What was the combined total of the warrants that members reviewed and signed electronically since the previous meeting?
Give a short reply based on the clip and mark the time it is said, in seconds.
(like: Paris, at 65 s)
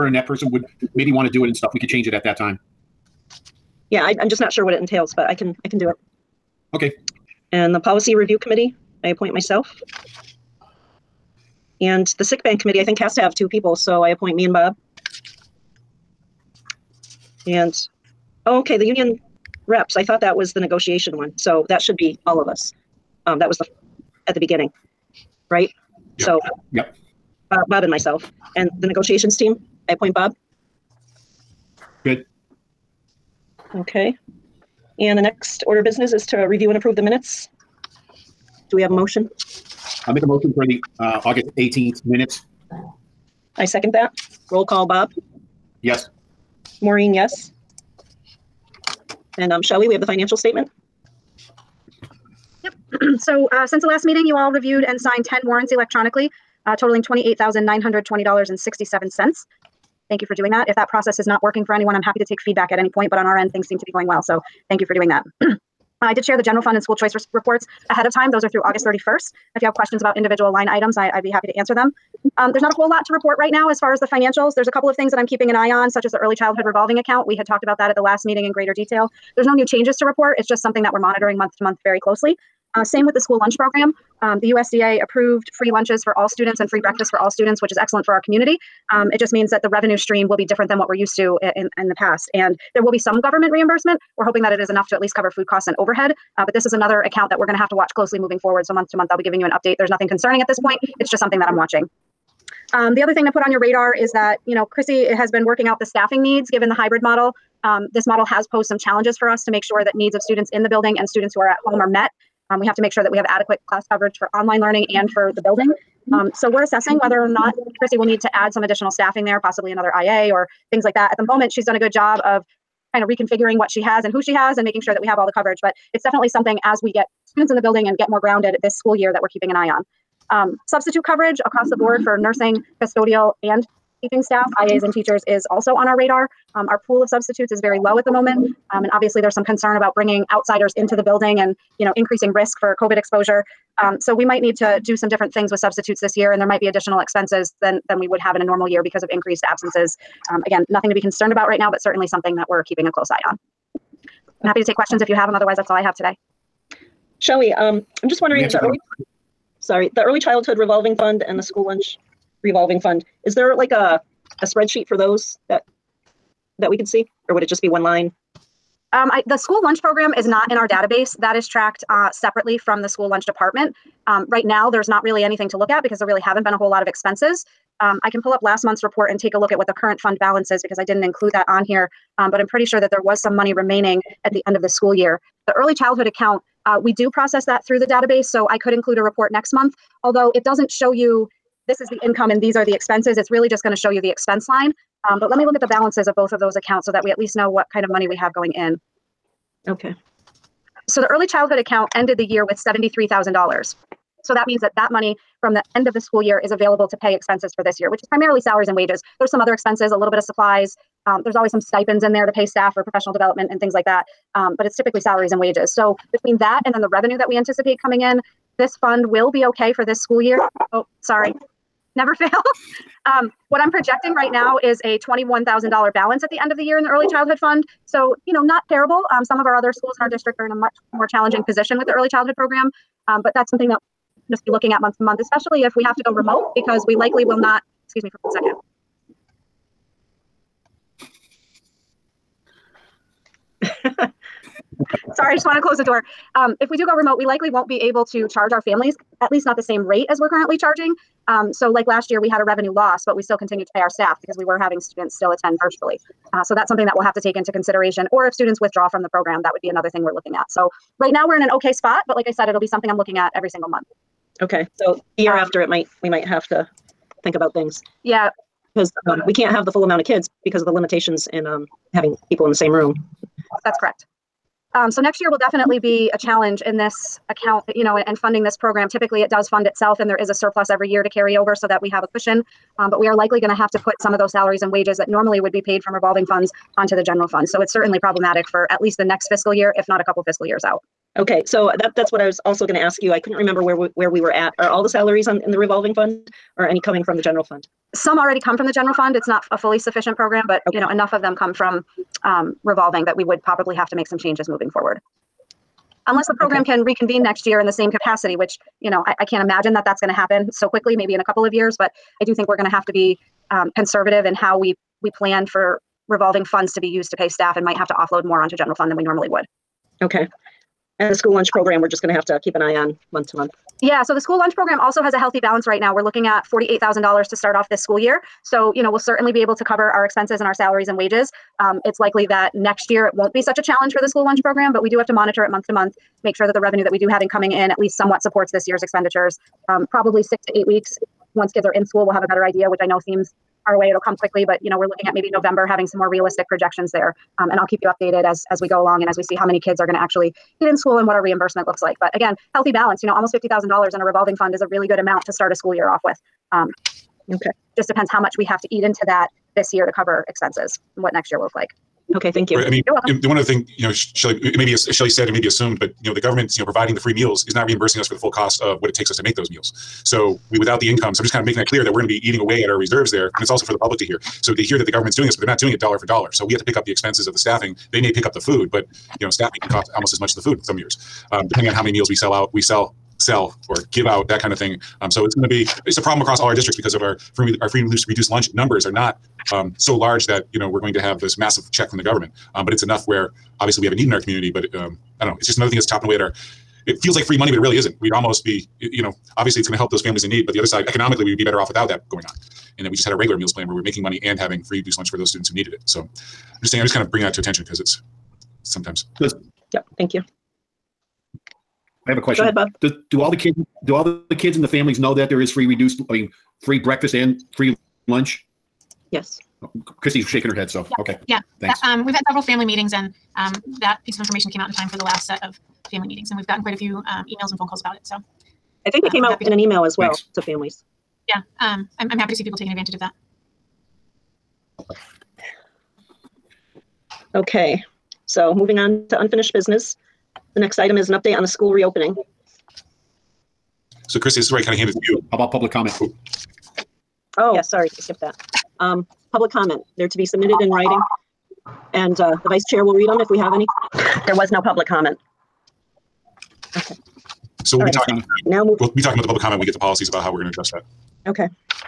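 $28,920.67, at 57 s.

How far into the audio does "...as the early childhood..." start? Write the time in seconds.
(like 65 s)
76 s.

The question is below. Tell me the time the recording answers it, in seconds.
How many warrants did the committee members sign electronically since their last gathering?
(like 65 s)
55 s.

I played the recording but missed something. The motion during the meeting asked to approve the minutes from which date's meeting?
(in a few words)
August 18th.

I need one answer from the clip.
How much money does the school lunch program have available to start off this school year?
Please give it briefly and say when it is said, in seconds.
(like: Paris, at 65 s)
$48,000, at 326 s.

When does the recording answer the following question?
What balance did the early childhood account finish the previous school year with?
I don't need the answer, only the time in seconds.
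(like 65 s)
202 s.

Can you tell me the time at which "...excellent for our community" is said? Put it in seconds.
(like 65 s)
87 s.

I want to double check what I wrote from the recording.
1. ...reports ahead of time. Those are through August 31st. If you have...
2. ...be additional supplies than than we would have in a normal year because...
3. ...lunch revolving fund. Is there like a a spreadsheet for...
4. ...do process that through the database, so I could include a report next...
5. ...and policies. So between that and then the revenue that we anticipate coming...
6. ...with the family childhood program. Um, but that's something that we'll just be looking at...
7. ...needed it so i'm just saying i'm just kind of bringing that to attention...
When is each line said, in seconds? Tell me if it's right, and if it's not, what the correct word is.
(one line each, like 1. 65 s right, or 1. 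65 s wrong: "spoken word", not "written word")
1. 67 s right
2. 146 s wrong: "expenses", not "supplies"
3. 161 s right
4. 186 s right
5. 215 s wrong: "wages", not "policies"
6. 231 s wrong: "early", not "family"
7. 405 s right.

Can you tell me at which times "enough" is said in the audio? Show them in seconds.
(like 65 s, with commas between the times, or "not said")
94 s, 300 s, 392 s.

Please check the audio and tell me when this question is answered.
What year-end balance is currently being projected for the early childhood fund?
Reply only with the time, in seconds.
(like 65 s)
224 s.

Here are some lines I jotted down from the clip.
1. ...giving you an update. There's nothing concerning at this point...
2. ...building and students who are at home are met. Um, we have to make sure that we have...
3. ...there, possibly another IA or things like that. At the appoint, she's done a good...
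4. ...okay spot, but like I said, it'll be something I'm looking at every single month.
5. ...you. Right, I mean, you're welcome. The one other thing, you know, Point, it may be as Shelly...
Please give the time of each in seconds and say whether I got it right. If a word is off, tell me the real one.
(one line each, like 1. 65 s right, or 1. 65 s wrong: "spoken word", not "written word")
1. 99 s right
2. 110 s right
3. 119 s wrong: "moment", not "appoint"
4. 261 s right
5. 362 s wrong: "Shelly", not "Point".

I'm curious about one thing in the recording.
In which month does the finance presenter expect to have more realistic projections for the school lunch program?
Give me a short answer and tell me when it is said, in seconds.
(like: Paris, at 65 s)
November, at 345 s.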